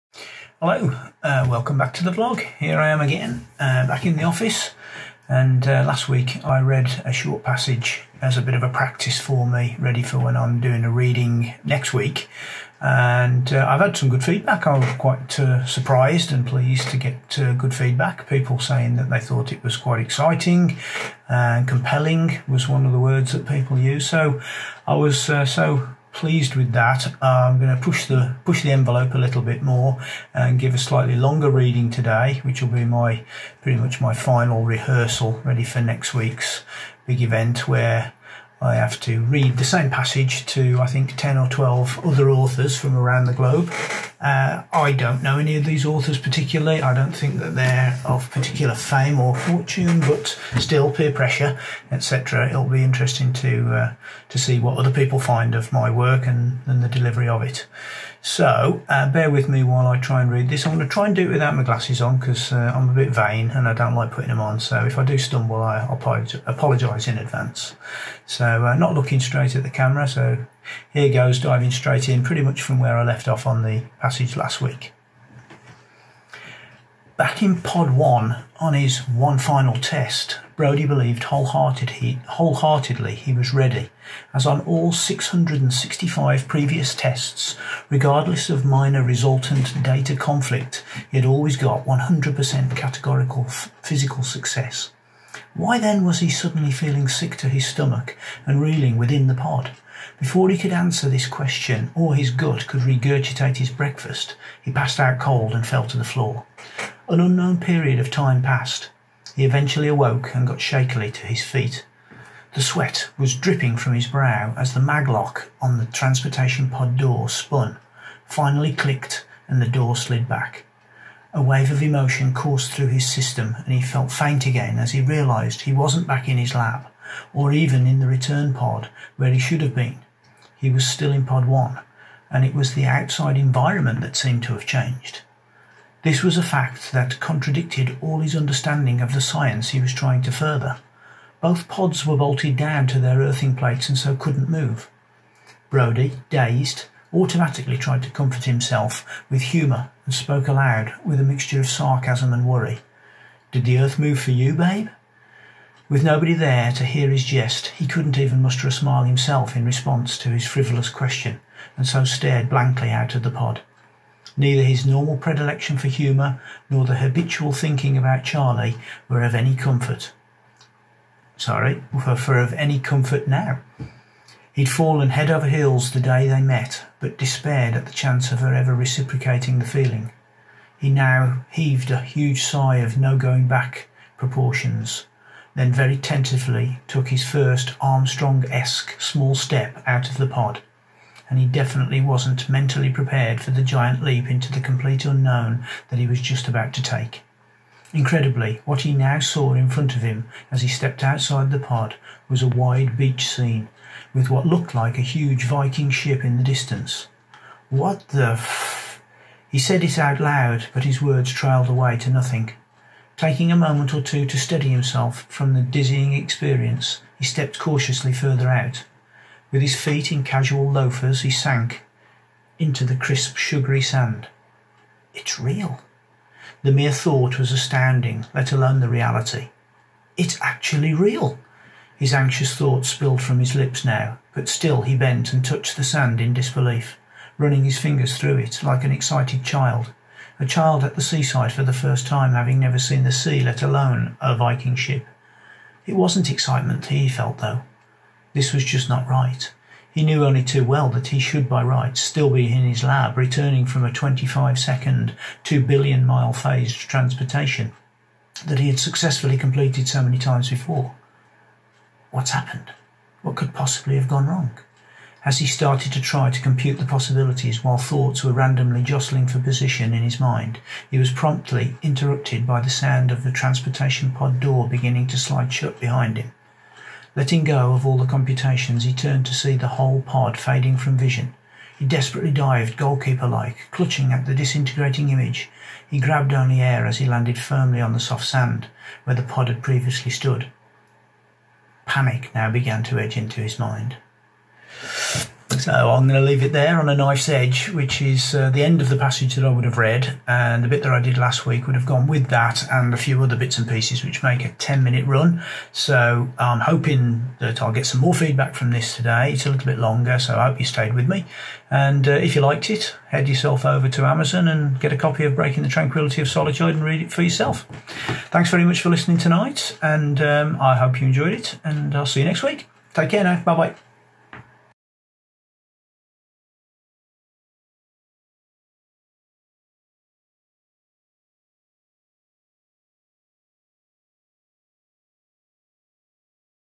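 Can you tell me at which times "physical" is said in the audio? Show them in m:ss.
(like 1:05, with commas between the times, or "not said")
1:33.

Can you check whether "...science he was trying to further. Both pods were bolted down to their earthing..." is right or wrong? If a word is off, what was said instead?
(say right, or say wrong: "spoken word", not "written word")
right.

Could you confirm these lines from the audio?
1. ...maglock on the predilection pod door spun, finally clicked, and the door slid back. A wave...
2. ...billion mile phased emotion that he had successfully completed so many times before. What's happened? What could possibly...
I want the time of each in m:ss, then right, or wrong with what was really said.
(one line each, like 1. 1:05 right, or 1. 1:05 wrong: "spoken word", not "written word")
1. 1:54 wrong: "transportation", not "predilection"
2. 4:15 wrong: "transportation", not "emotion".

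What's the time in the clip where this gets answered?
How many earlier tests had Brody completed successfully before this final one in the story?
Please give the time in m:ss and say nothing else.
1:24.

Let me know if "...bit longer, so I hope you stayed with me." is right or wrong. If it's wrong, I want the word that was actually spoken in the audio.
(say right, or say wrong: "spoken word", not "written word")
right.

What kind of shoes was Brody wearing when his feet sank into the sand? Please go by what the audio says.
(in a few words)
casual loafers.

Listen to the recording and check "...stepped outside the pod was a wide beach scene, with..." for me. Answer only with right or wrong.
right.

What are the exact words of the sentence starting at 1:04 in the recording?
So if I do stumble, I apologise in advance.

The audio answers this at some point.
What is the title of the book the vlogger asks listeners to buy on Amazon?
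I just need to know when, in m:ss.
5:15.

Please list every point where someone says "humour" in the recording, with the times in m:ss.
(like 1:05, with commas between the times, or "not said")
2:29, 2:45.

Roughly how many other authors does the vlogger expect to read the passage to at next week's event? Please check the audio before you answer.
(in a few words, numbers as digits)
10 or 12.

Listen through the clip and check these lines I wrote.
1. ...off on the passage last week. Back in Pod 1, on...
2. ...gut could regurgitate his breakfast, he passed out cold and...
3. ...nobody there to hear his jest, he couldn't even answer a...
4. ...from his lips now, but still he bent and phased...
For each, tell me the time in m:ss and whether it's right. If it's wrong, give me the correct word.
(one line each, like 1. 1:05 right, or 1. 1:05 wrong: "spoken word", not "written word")
1. 1:13 right
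2. 1:42 right
3. 2:36 wrong: "muster", not "answer"
4. 3:53 wrong: "touched", not "phased".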